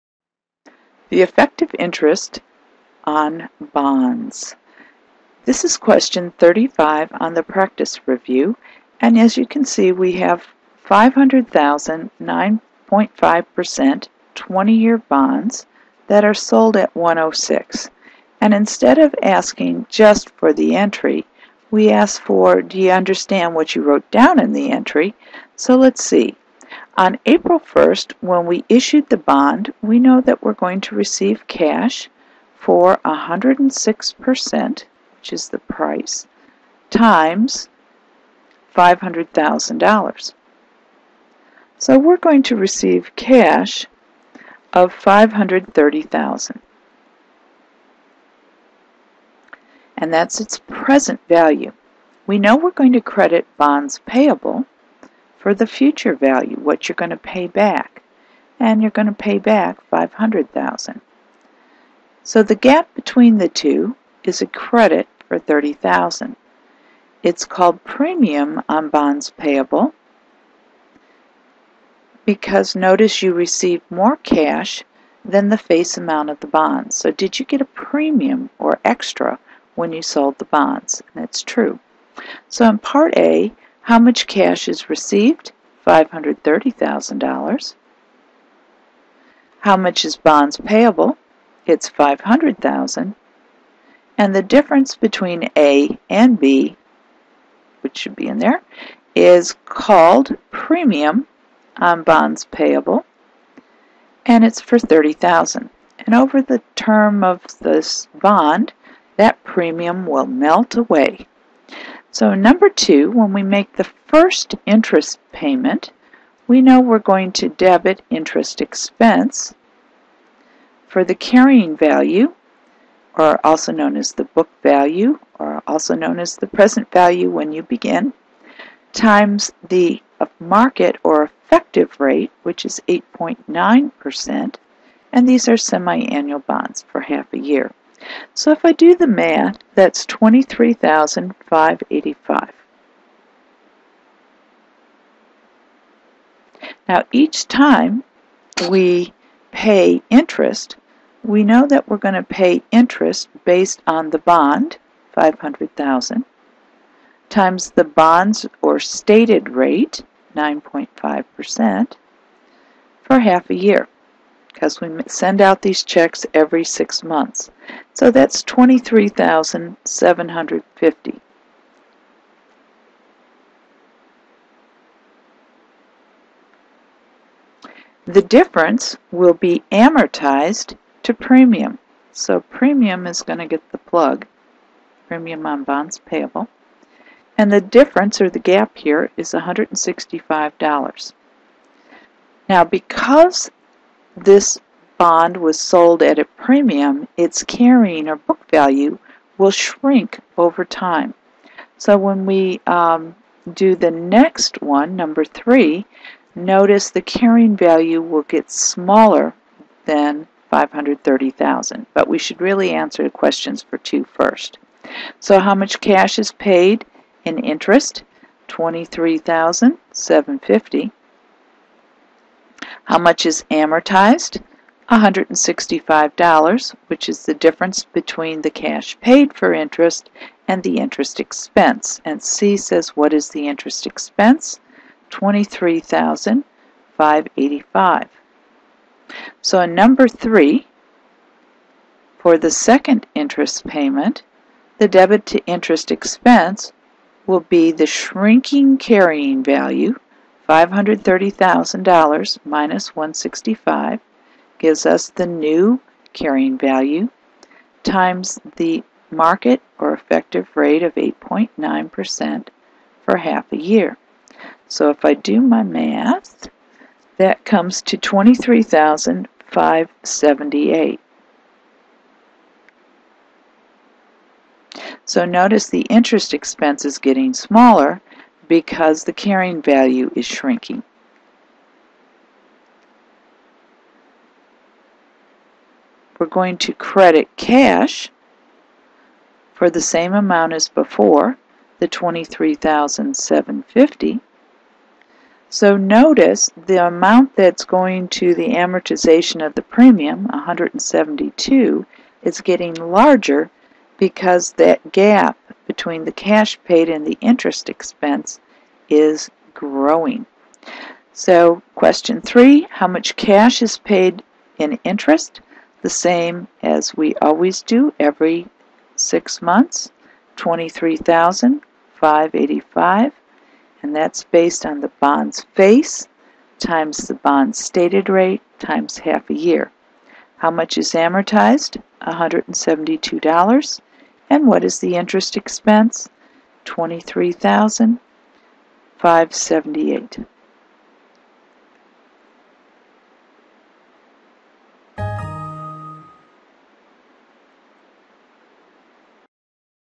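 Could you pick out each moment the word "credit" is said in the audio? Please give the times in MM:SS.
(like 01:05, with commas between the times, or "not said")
00:53, 01:04, 04:46.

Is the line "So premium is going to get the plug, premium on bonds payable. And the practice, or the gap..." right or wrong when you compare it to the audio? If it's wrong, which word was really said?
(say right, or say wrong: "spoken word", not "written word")
wrong: "difference", not "practice".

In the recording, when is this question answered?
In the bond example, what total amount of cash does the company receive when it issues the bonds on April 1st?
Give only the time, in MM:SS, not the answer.
00:44.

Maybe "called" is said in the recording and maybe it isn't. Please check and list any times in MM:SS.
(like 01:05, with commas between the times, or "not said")
01:07, 01:39.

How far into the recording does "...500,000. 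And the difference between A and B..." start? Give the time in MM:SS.
01:31.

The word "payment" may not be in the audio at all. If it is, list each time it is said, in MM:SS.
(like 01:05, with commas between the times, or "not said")
01:55, 04:03.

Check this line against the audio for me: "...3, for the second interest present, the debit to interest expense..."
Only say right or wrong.
wrong.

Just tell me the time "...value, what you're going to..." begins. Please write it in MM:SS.
00:56.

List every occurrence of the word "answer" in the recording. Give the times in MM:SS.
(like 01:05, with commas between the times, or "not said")
03:32.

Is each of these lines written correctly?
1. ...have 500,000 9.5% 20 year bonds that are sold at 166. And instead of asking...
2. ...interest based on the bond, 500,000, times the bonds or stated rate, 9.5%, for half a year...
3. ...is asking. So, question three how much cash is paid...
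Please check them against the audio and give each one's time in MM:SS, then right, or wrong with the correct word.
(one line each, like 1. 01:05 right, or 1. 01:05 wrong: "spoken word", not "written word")
1. 00:10 wrong: "106", not "166"
2. 02:32 right
3. 05:08 wrong: "growing", not "asking".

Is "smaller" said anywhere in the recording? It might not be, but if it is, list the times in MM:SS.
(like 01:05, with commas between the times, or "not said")
03:28, 04:37.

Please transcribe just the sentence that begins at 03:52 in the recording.
And C says, what is the interest expense?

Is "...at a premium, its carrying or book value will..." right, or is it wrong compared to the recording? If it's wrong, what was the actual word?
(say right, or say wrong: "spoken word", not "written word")
right.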